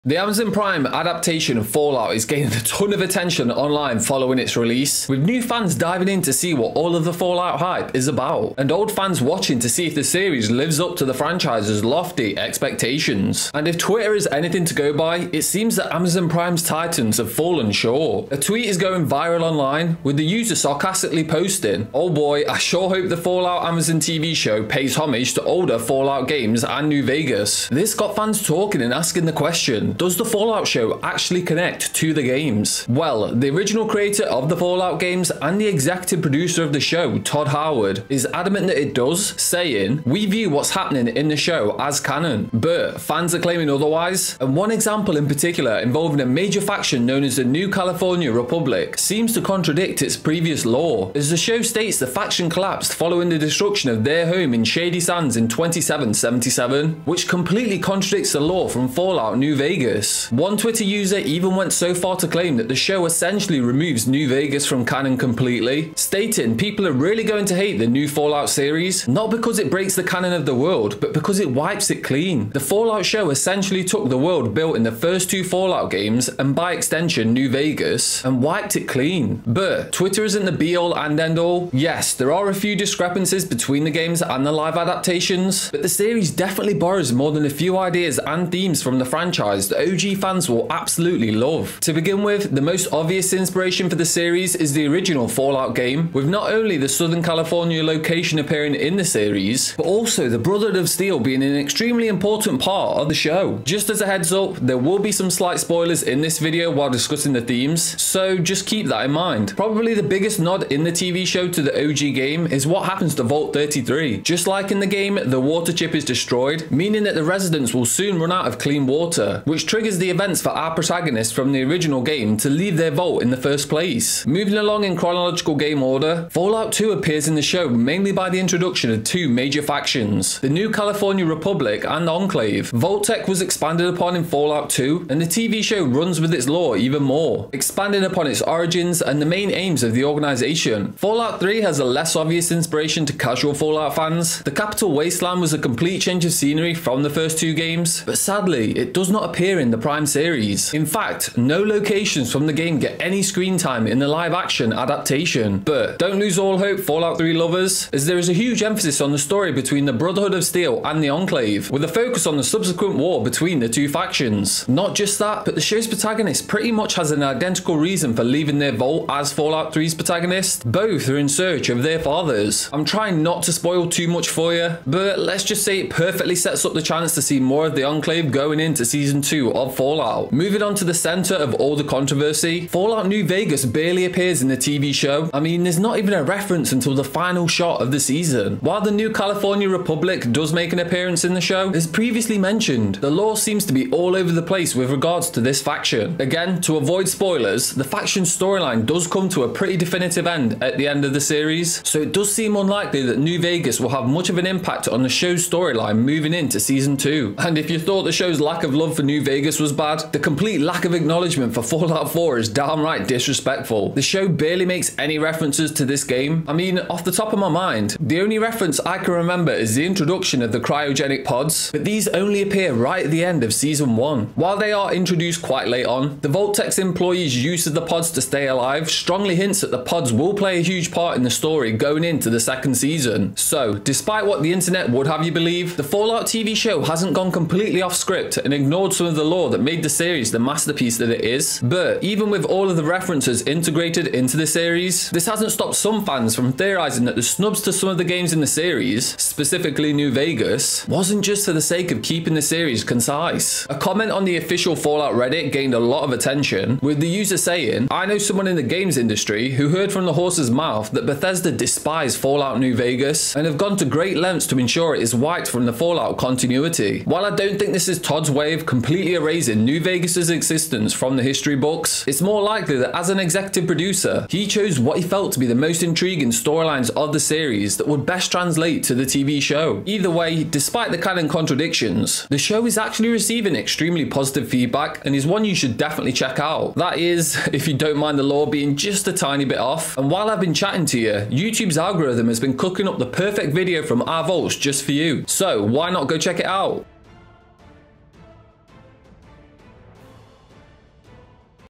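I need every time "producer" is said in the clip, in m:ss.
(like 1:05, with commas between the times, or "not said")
0:36, 4:33.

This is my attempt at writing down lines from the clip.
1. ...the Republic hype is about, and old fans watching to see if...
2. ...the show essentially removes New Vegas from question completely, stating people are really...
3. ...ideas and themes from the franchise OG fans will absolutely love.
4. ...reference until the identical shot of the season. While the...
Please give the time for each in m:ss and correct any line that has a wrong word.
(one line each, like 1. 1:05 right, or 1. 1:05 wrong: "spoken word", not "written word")
1. 0:07 wrong: "Fallout", not "Republic"
2. 1:02 wrong: "canon", not "question"
3. 1:27 right
4. 3:06 wrong: "final", not "identical".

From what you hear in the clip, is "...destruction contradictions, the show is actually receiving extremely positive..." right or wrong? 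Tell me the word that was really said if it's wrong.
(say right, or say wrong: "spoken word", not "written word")
wrong: "canon", not "destruction".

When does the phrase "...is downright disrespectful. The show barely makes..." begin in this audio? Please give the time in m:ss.
3:32.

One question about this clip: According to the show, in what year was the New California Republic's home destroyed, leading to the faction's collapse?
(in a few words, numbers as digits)
2777.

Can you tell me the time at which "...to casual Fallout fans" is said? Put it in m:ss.
2:23.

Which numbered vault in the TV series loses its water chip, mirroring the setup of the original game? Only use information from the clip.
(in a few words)
Vault 33.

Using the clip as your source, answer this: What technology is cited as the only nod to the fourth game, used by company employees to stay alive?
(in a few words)
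cryogenic pods.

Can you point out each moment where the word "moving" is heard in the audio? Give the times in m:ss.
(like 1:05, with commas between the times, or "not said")
2:04, 3:00, 3:25.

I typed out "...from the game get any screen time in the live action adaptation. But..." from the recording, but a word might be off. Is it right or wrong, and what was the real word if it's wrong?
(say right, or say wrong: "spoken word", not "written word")
right.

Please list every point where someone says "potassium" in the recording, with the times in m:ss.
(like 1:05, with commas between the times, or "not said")
not said.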